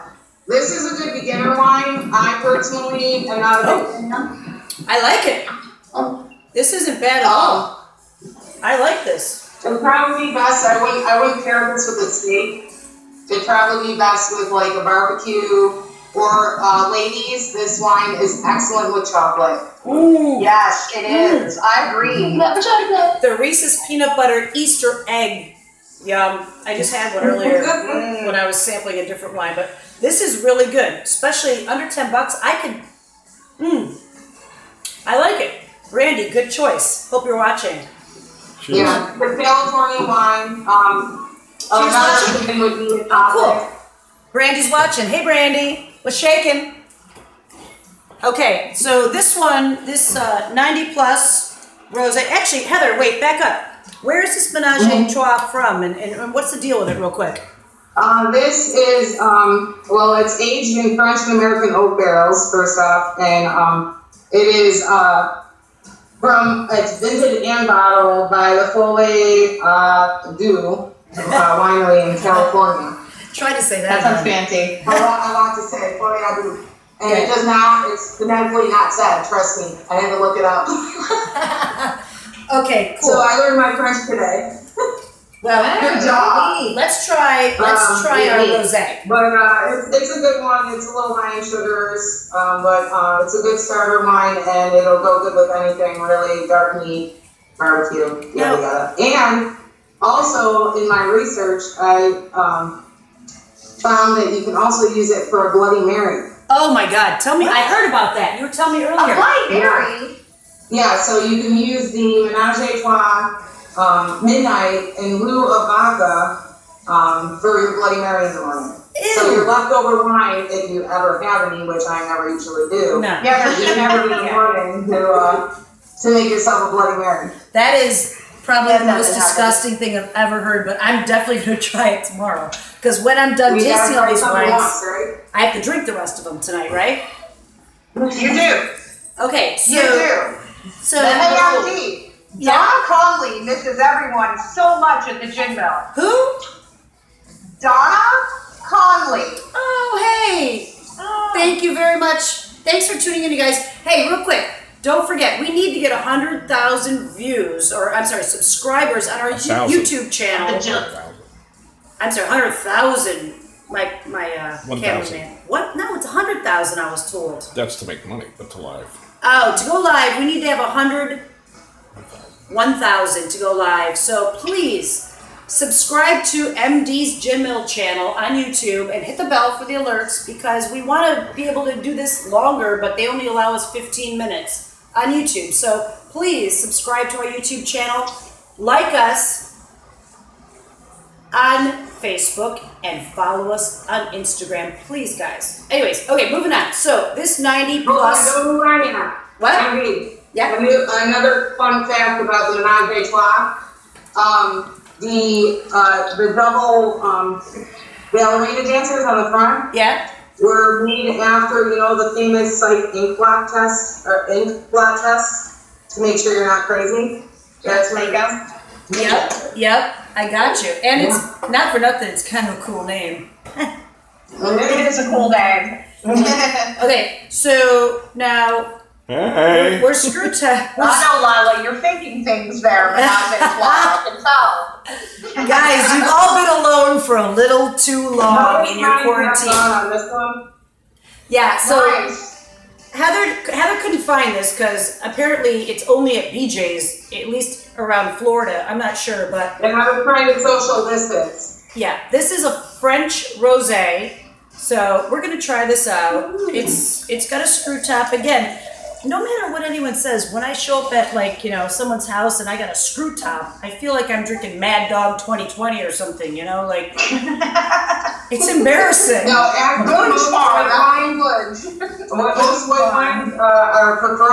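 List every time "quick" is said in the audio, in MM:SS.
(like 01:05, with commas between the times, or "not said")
00:57, 02:34.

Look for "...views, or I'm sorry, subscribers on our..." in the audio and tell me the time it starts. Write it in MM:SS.
02:37.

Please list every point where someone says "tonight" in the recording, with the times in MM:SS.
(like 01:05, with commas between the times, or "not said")
02:16.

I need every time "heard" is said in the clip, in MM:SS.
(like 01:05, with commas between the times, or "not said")
01:47, 02:10.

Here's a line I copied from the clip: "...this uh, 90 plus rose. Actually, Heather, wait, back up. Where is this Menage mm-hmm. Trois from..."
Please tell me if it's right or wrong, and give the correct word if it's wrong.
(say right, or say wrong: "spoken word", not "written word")
right.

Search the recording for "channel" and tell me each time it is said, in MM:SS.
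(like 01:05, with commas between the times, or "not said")
02:40, 02:57, 03:07.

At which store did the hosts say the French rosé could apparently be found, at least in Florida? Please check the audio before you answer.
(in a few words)
BJ's.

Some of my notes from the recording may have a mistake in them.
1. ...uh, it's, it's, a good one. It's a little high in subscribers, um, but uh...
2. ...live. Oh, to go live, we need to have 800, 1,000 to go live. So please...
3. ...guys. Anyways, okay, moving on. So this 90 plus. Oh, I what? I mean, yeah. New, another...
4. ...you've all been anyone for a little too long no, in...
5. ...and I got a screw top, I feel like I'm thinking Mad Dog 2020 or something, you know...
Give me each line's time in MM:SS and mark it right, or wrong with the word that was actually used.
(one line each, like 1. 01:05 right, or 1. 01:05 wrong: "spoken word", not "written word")
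1. 01:29 wrong: "sugars", not "subscribers"
2. 02:48 wrong: "100", not "800"
3. 03:15 right
4. 03:55 wrong: "alone", not "anyone"
5. 04:22 wrong: "drinking", not "thinking".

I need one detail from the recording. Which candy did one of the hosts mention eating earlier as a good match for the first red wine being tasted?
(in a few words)
Reese's peanut butter Easter egg.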